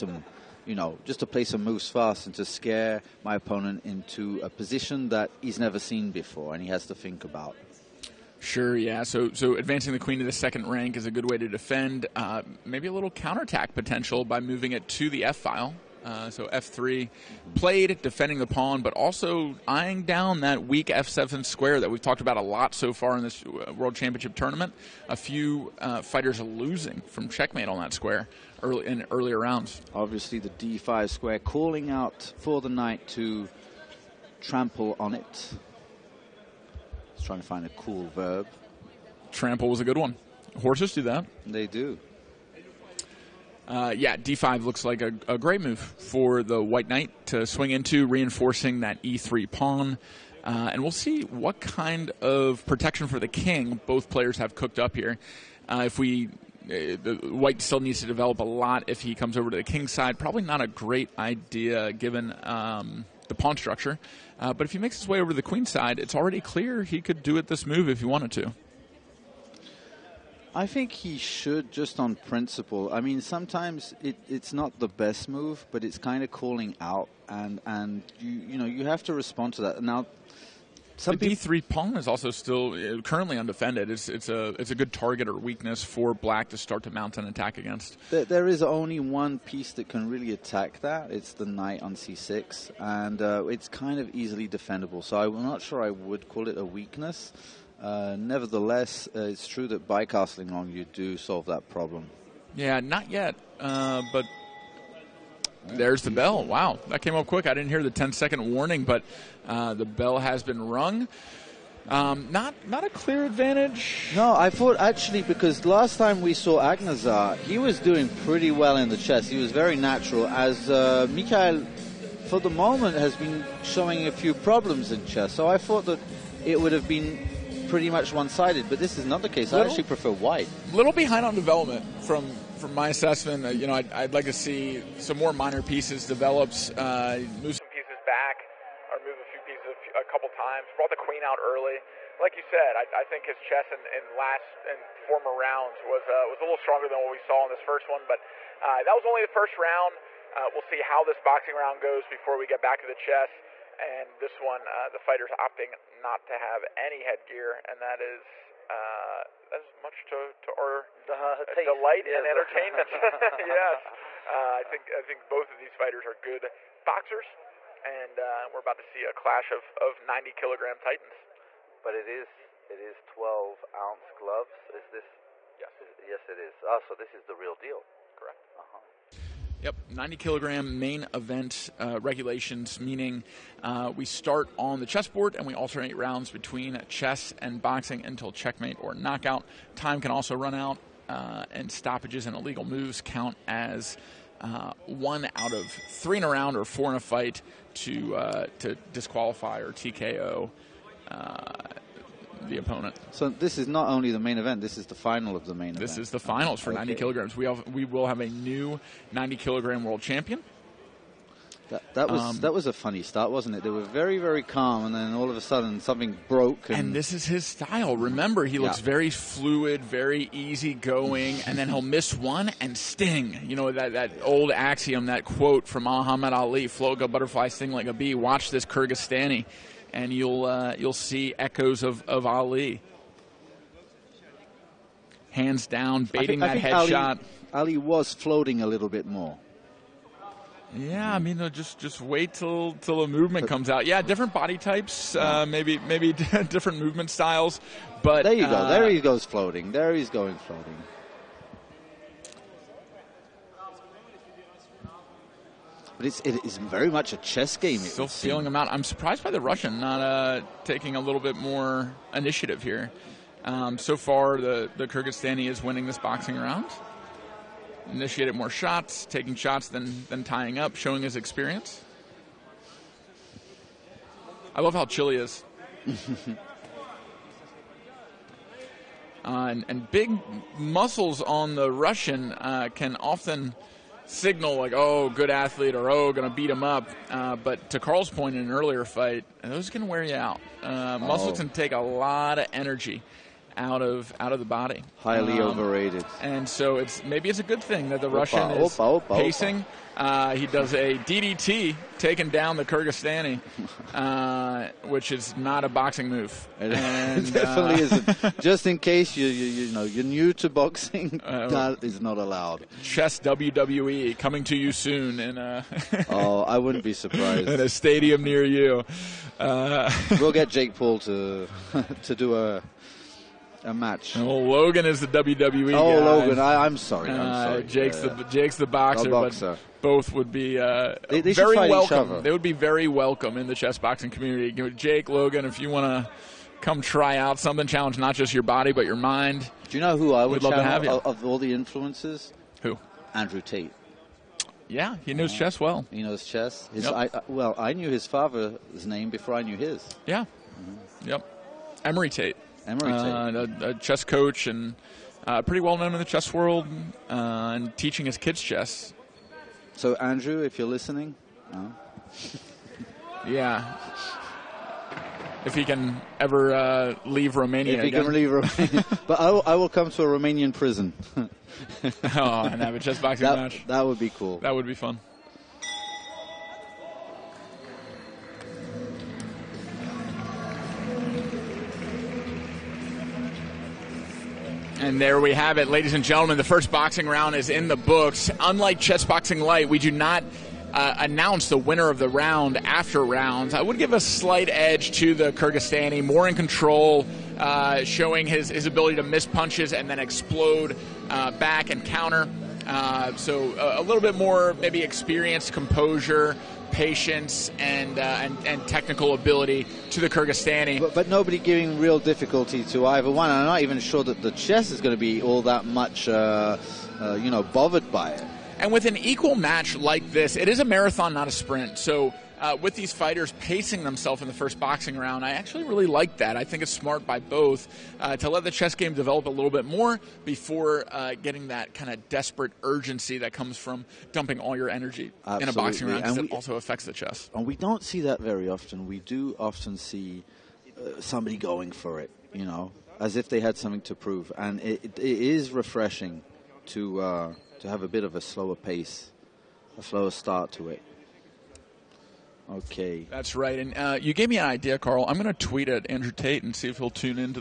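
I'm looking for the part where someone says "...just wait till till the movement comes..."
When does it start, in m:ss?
4:01.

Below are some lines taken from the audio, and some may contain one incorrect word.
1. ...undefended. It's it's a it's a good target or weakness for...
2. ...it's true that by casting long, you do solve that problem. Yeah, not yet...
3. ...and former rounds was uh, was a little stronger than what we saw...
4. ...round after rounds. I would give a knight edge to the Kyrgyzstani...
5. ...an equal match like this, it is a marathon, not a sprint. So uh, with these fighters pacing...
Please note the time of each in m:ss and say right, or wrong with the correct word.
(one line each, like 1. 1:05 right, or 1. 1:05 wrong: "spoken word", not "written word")
1. 1:23 right
2. 1:39 right
3. 2:24 right
4. 6:32 wrong: "slight", not "knight"
5. 6:58 right.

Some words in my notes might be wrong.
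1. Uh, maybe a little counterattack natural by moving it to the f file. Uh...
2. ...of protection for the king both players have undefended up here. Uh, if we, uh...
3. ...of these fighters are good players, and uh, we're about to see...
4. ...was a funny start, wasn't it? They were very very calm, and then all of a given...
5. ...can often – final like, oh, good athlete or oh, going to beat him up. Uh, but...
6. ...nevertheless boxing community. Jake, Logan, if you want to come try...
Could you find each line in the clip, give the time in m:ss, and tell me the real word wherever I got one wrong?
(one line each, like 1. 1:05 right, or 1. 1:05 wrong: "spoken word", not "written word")
1. 0:12 wrong: "potential", not "natural"
2. 0:52 wrong: "cooked", not "undefended"
3. 2:45 wrong: "boxers", not "players"
4. 3:32 wrong: "sudden", not "given"
5. 4:42 wrong: "signal", not "final"
6. 5:33 wrong: "chess", not "nevertheless".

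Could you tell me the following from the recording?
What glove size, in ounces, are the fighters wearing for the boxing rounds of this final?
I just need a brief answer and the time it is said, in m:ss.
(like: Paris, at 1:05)
12, at 2:53.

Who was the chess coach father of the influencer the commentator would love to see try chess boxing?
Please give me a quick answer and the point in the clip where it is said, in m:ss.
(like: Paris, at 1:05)
Emory Tate, at 5:51.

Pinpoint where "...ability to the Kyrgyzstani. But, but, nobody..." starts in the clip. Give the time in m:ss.
6:49.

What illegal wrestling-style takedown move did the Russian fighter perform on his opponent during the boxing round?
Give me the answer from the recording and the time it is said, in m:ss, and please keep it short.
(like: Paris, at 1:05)
DDT, at 5:00.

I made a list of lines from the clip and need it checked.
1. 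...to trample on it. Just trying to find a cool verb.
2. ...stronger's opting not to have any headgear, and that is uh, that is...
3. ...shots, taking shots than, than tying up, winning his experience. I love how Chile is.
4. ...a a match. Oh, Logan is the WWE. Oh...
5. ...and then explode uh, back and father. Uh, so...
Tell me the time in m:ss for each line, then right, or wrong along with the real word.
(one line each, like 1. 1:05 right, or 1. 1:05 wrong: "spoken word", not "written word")
1. 0:33 right
2. 2:34 wrong: "fighter", not "stronger"
3. 4:28 wrong: "showing", not "winning"
4. 5:22 right
5. 6:39 wrong: "counter", not "father".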